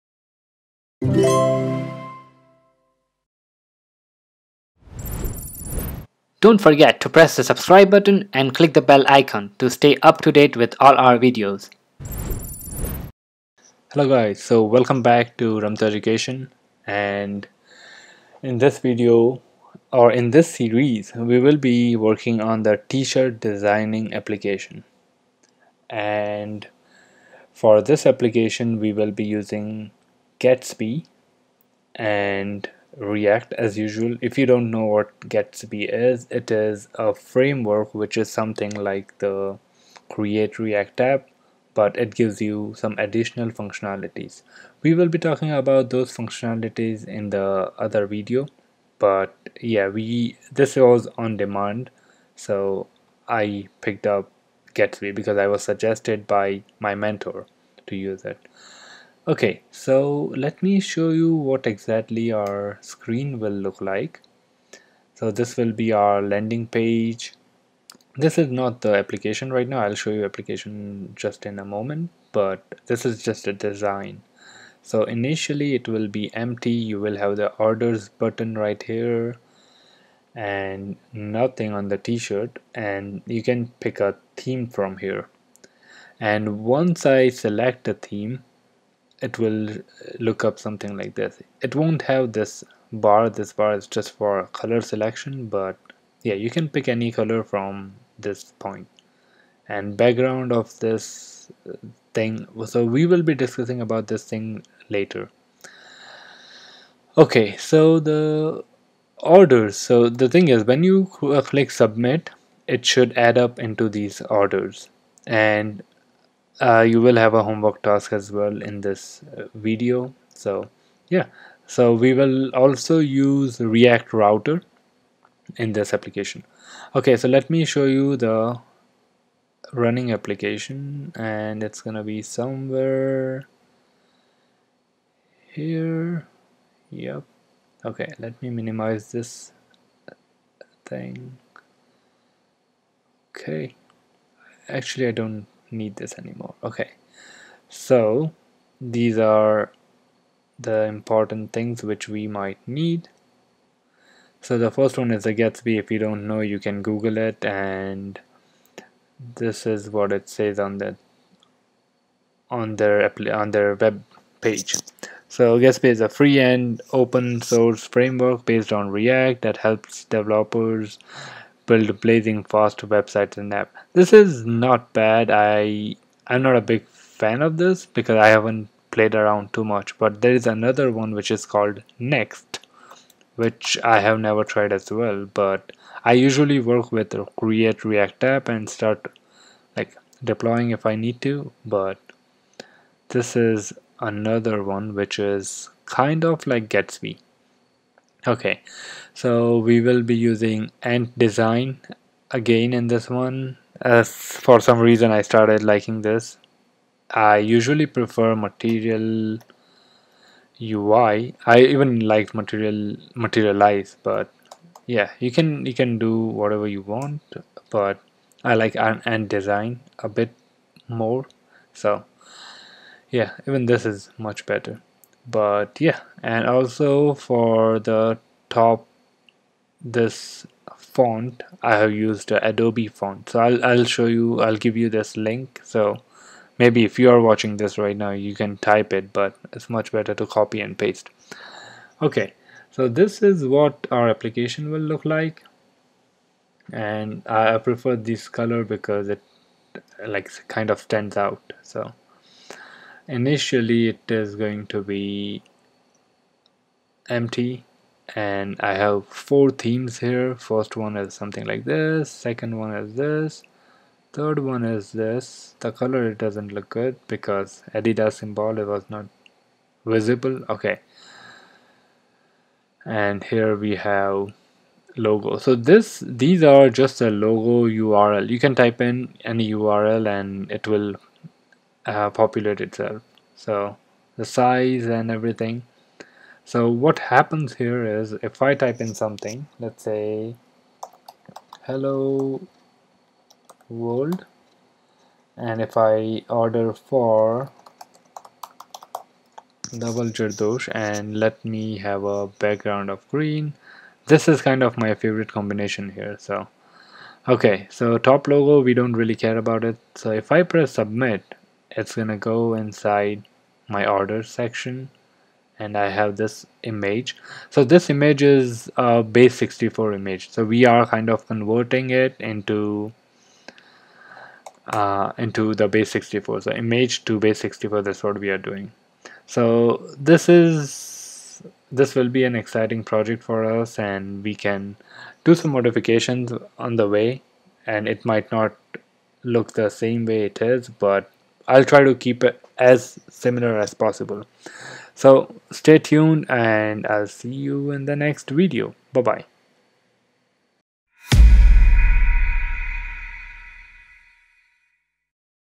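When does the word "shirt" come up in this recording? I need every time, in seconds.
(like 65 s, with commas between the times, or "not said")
22 s, 81 s.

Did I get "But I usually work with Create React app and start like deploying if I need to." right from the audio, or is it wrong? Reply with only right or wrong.
right.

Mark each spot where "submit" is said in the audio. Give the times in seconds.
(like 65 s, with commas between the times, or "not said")
111 s, 310 s.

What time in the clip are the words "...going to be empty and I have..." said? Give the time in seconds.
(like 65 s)
254 s.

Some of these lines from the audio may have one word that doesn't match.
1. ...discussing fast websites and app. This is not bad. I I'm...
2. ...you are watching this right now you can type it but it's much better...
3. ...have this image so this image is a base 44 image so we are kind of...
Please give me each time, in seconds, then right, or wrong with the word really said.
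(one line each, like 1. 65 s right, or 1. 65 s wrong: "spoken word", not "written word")
1. 172 s wrong: "blazing", not "discussing"
2. 236 s right
3. 315 s wrong: "64", not "44".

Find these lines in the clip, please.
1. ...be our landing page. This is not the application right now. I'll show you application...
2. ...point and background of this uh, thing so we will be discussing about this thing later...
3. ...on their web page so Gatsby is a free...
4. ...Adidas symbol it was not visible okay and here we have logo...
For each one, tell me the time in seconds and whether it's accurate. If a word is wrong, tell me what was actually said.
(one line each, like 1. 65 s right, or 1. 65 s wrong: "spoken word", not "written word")
1. 65 s right
2. 98 s right
3. 163 s right
4. 267 s right.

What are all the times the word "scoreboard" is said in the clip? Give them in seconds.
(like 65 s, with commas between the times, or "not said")
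not said.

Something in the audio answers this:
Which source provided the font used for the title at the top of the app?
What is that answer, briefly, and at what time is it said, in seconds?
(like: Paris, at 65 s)
Adobe, at 232 s.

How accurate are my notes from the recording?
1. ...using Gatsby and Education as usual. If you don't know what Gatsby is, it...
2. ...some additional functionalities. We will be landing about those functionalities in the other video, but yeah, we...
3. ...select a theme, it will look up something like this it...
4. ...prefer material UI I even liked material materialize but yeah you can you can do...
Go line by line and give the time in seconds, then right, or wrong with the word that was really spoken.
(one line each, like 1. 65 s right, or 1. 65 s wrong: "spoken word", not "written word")
1. 29 s wrong: "React", not "Education"
2. 42 s wrong: "talking", not "landing"
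3. 87 s right
4. 207 s right.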